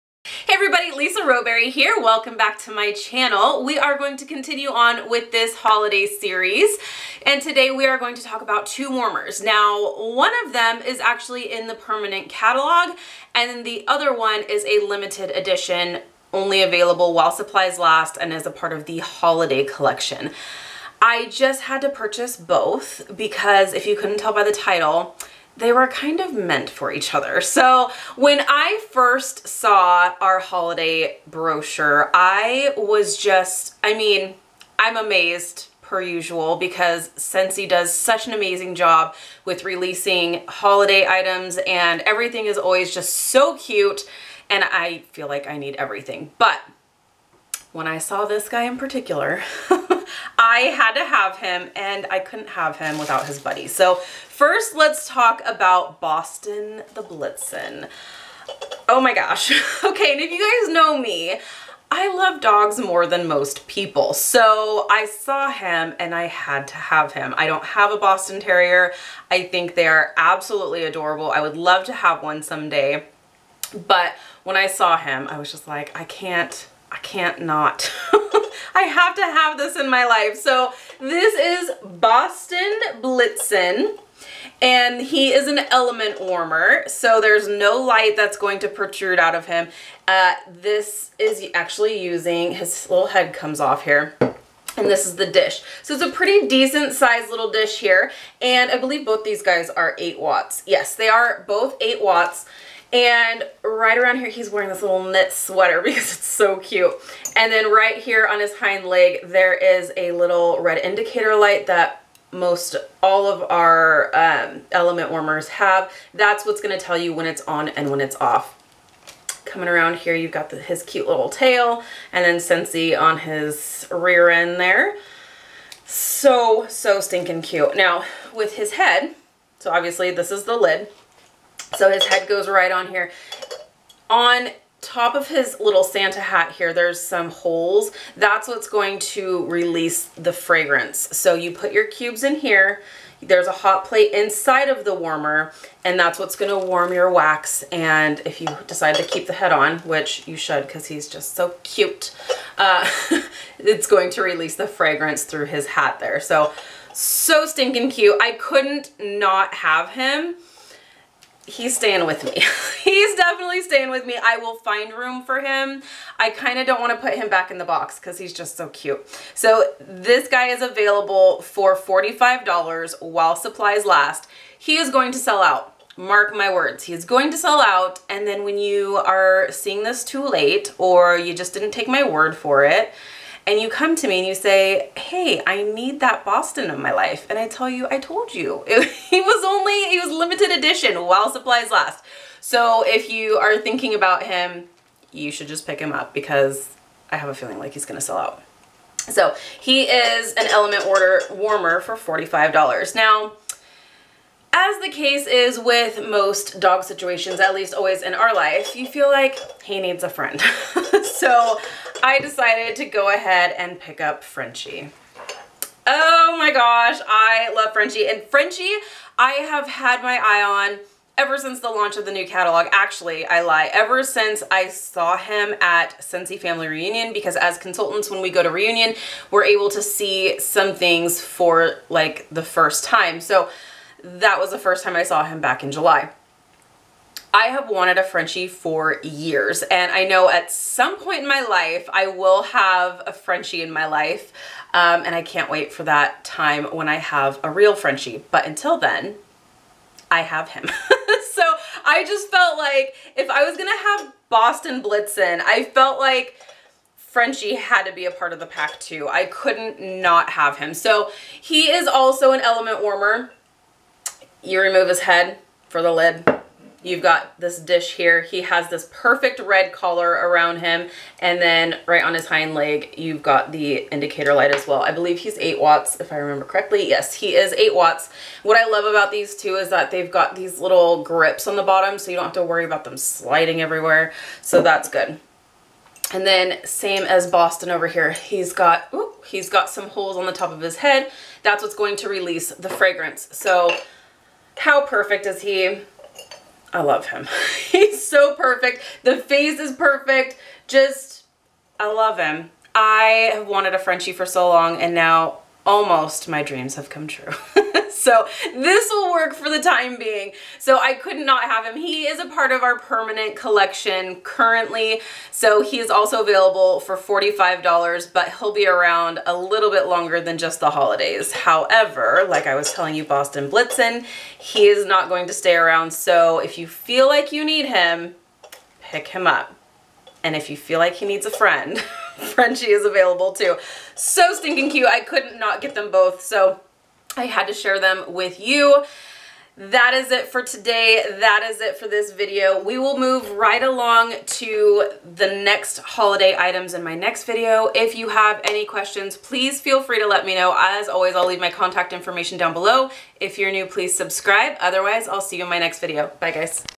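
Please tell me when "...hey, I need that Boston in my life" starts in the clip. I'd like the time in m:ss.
3:04.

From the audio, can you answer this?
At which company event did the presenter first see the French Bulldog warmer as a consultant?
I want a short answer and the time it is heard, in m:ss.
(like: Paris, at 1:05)
Scentsy Family Reunion, at 3:46.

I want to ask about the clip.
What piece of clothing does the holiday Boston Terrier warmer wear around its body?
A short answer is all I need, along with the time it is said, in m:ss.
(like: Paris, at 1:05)
knit sweater, at 1:45.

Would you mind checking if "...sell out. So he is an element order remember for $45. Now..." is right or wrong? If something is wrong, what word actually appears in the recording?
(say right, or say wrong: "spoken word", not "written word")
wrong: "warmer", not "remember".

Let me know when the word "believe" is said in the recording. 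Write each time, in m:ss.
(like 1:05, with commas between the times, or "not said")
1:38, 4:34.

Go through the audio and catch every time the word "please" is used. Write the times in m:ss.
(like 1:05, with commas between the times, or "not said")
5:49, 5:53.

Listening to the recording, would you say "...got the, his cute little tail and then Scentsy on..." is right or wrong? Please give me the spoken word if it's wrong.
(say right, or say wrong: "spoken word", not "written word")
right.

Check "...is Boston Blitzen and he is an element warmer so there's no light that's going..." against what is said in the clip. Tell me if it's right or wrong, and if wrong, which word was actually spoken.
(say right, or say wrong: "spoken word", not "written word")
right.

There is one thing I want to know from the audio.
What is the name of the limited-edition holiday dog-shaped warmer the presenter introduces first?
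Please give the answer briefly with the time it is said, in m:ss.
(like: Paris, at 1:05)
Boston the Blitzen, at 0:56.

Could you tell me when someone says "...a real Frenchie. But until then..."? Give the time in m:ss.
4:07.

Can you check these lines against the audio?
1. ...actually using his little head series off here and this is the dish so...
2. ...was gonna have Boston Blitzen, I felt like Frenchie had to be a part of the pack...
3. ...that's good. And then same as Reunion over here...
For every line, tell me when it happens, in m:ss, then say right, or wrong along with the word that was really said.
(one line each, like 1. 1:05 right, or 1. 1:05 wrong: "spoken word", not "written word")
1. 1:31 wrong: "comes", not "series"
2. 4:13 right
3. 4:44 wrong: "Boston", not "Reunion".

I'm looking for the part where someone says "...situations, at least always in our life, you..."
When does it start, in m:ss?
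3:26.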